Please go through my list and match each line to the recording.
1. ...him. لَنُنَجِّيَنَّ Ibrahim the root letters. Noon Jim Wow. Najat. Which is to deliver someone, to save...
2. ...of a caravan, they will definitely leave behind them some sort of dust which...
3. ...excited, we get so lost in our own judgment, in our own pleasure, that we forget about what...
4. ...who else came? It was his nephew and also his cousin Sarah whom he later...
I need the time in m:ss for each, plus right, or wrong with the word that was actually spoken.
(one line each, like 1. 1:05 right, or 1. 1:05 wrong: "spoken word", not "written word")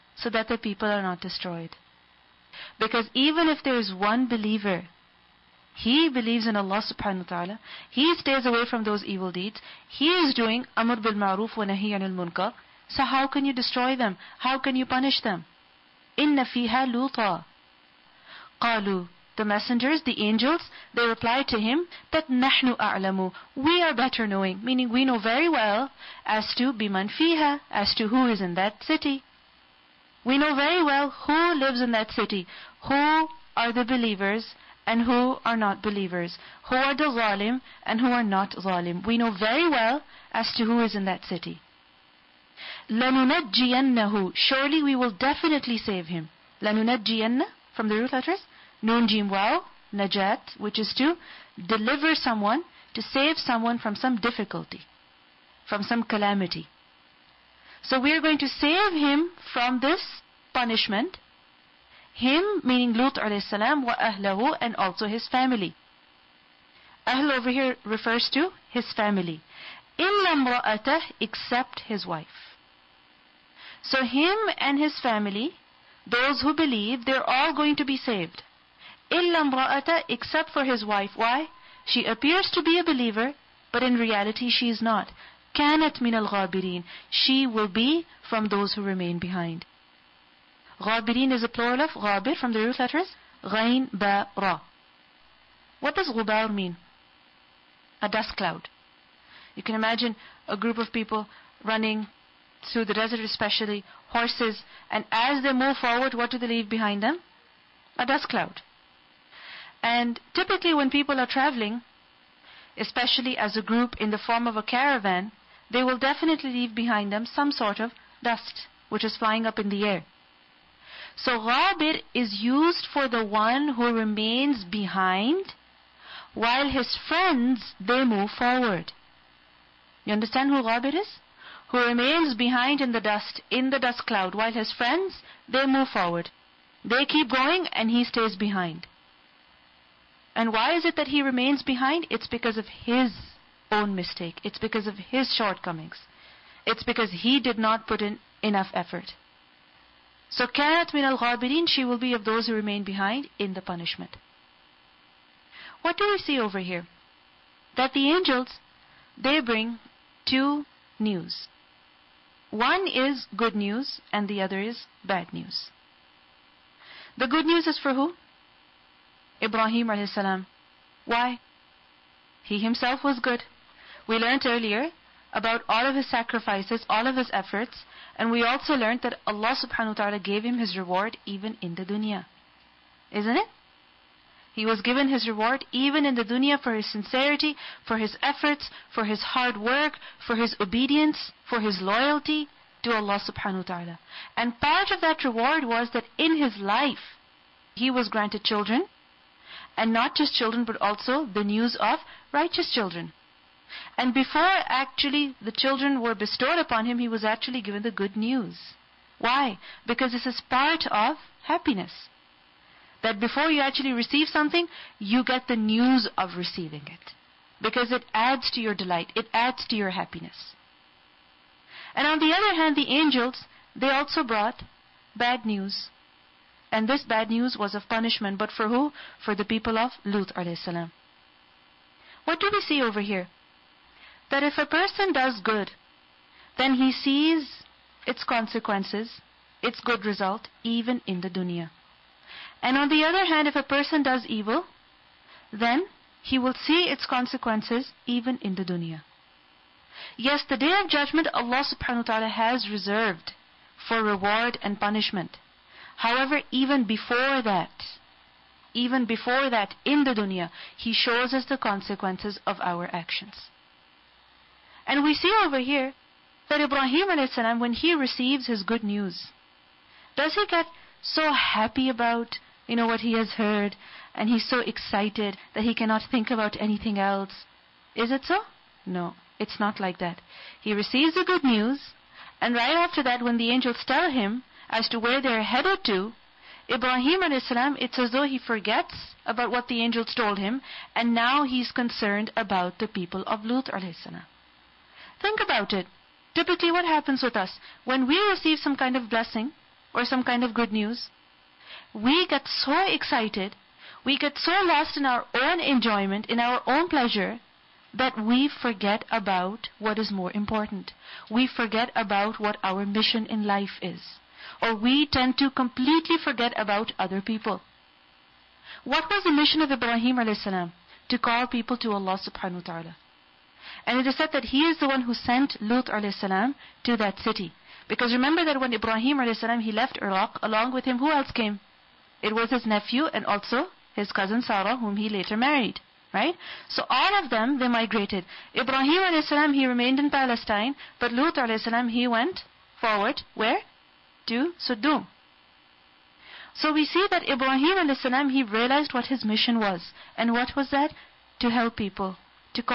1. 0:46 wrong: "From", not "Ibrahim"
2. 1:54 right
3. 5:02 wrong: "enjoyment", not "judgment"
4. 5:30 right.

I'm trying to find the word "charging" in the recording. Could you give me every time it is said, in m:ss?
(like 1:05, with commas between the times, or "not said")
not said.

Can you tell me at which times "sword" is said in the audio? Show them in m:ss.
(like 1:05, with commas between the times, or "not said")
not said.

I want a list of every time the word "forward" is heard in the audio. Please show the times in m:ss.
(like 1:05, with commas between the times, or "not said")
1:45, 2:08, 2:15, 5:42.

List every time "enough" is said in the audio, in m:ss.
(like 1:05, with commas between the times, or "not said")
2:28.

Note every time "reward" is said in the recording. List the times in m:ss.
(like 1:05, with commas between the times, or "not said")
3:00, 3:05, 3:15, 4:14.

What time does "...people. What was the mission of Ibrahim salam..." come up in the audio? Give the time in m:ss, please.
5:17.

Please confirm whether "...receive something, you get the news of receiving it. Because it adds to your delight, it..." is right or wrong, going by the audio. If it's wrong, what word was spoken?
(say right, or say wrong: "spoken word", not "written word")
right.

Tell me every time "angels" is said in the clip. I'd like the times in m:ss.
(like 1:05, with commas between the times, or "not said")
0:20, 2:38, 3:42, 4:43, 4:49.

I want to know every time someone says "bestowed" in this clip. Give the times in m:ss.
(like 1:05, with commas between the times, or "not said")
3:26.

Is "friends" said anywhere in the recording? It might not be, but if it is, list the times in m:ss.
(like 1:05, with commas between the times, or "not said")
2:07, 2:14.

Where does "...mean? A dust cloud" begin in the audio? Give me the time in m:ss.
1:36.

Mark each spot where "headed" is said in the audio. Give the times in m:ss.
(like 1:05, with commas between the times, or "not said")
4:45.